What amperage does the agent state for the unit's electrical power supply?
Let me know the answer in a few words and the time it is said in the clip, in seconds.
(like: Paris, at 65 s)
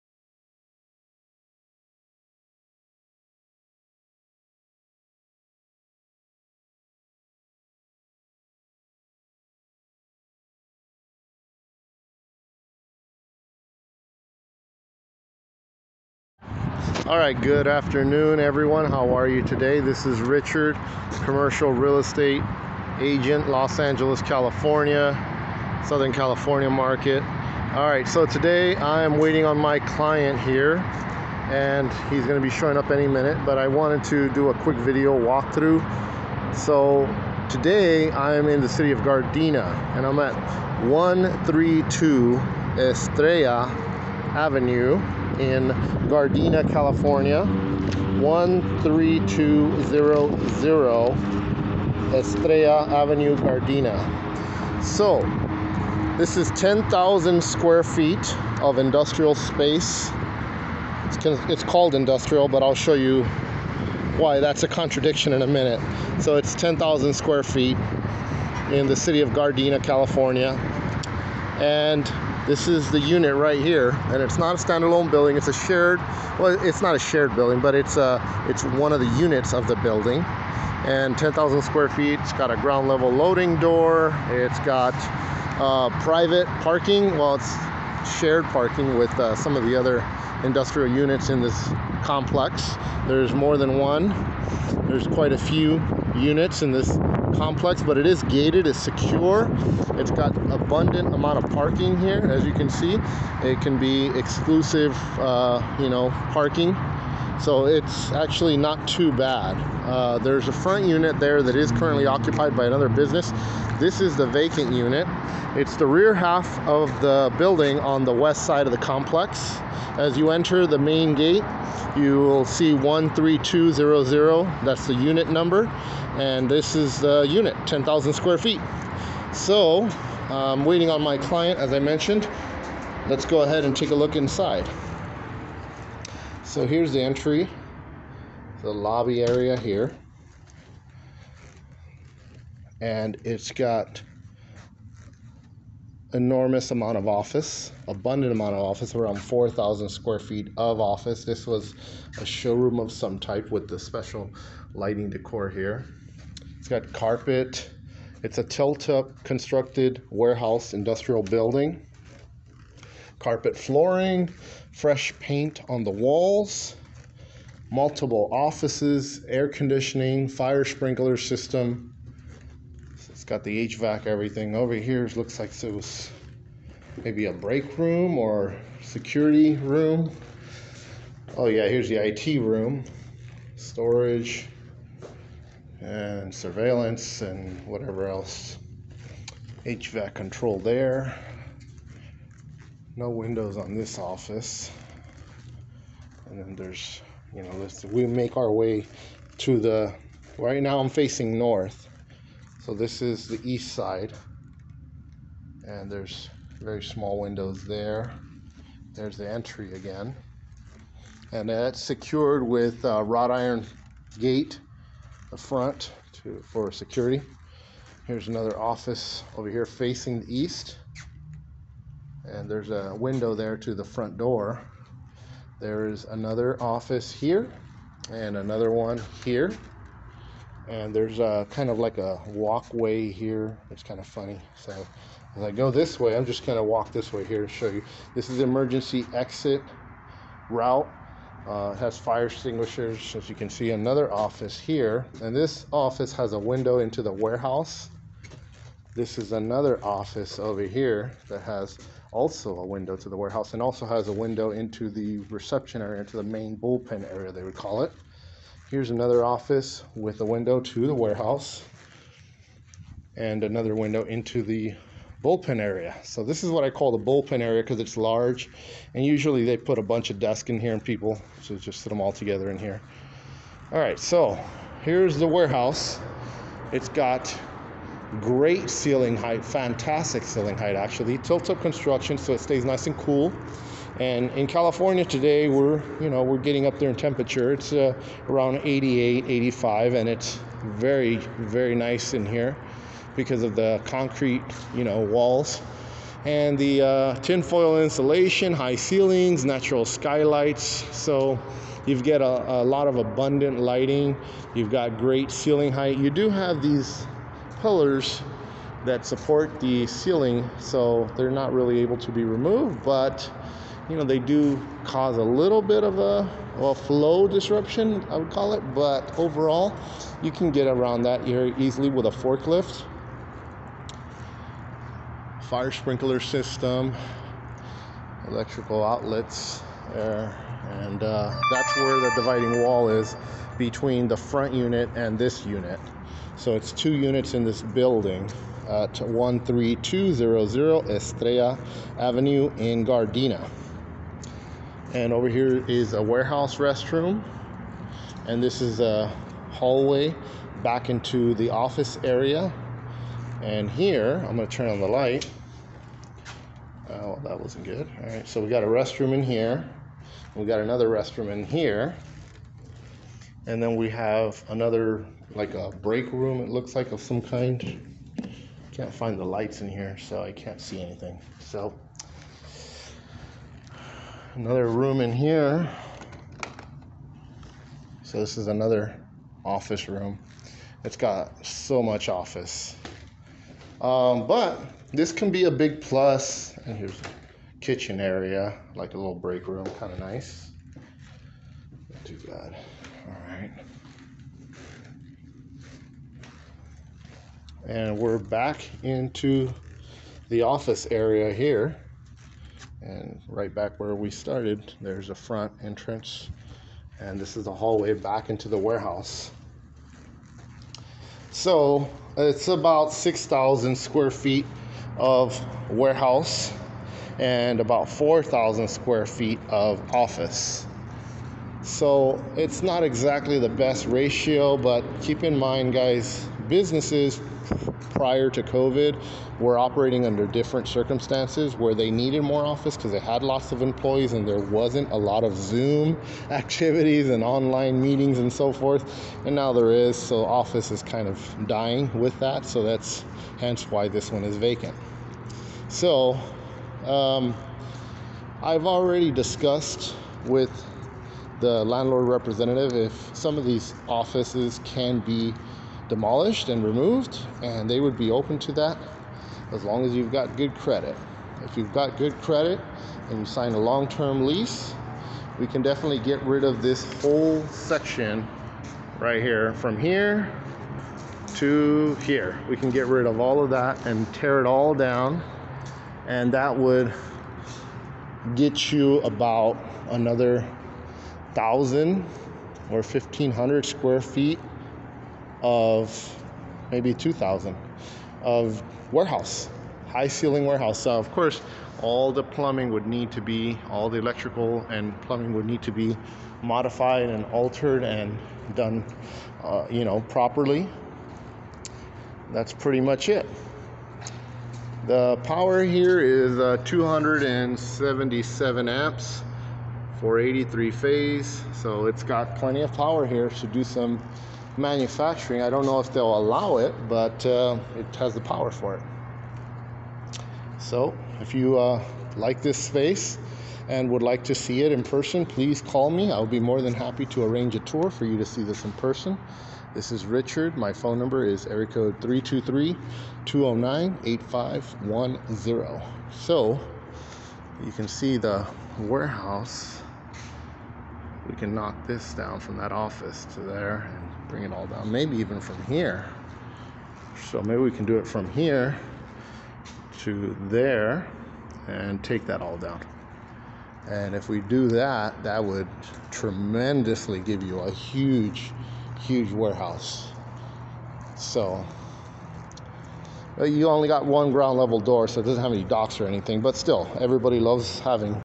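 277 amps, at 506 s.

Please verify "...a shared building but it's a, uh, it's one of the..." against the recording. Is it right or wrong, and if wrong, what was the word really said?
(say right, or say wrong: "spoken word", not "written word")
right.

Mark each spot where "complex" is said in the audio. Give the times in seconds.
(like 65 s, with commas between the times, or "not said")
92 s, 97 s, 118 s.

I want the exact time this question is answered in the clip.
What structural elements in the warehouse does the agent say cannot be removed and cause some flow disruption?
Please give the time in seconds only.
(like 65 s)
306 s.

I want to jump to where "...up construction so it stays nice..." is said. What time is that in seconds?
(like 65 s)
281 s.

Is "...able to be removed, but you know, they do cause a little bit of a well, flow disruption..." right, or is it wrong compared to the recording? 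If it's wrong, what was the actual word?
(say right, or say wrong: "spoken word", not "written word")
right.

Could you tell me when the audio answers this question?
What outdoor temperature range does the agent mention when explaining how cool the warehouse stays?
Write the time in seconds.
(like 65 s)
288 s.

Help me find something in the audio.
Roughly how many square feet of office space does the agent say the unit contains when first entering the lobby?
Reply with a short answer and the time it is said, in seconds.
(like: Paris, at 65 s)
4,000, at 148 s.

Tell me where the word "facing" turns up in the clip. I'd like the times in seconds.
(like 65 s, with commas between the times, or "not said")
200 s, 219 s.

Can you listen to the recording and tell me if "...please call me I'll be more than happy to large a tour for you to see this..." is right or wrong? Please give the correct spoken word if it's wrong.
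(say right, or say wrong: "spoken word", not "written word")
wrong: "arrange", not "large".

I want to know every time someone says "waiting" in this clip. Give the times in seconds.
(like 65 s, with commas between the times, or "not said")
29 s, 130 s.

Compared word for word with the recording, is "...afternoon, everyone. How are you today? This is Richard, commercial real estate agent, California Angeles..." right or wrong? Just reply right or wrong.
wrong.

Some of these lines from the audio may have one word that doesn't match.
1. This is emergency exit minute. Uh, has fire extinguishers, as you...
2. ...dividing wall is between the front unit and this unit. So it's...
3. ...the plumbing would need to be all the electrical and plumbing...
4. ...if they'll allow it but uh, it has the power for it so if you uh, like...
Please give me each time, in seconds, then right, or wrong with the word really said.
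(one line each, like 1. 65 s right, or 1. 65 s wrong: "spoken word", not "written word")
1. 238 s wrong: "route", not "minute"
2. 332 s right
3. 492 s right
4. 515 s right.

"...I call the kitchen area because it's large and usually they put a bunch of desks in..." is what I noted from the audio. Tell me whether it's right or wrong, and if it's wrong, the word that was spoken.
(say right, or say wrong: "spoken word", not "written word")
wrong: "bullpen", not "kitchen".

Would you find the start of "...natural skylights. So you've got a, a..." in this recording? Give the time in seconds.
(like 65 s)
299 s.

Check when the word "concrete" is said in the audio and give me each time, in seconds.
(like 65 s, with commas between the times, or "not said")
293 s.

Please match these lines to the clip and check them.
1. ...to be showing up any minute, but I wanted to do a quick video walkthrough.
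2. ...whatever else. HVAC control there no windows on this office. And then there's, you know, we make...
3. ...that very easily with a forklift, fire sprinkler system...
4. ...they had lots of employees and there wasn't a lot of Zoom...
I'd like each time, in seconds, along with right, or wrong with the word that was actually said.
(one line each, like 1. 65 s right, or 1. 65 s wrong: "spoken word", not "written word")
1. 32 s right
2. 187 s right
3. 321 s right
4. 432 s right.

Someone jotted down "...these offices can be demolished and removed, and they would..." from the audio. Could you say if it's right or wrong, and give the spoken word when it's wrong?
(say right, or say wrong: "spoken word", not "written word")
right.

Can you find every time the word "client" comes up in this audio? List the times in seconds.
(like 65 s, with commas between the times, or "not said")
29 s, 131 s.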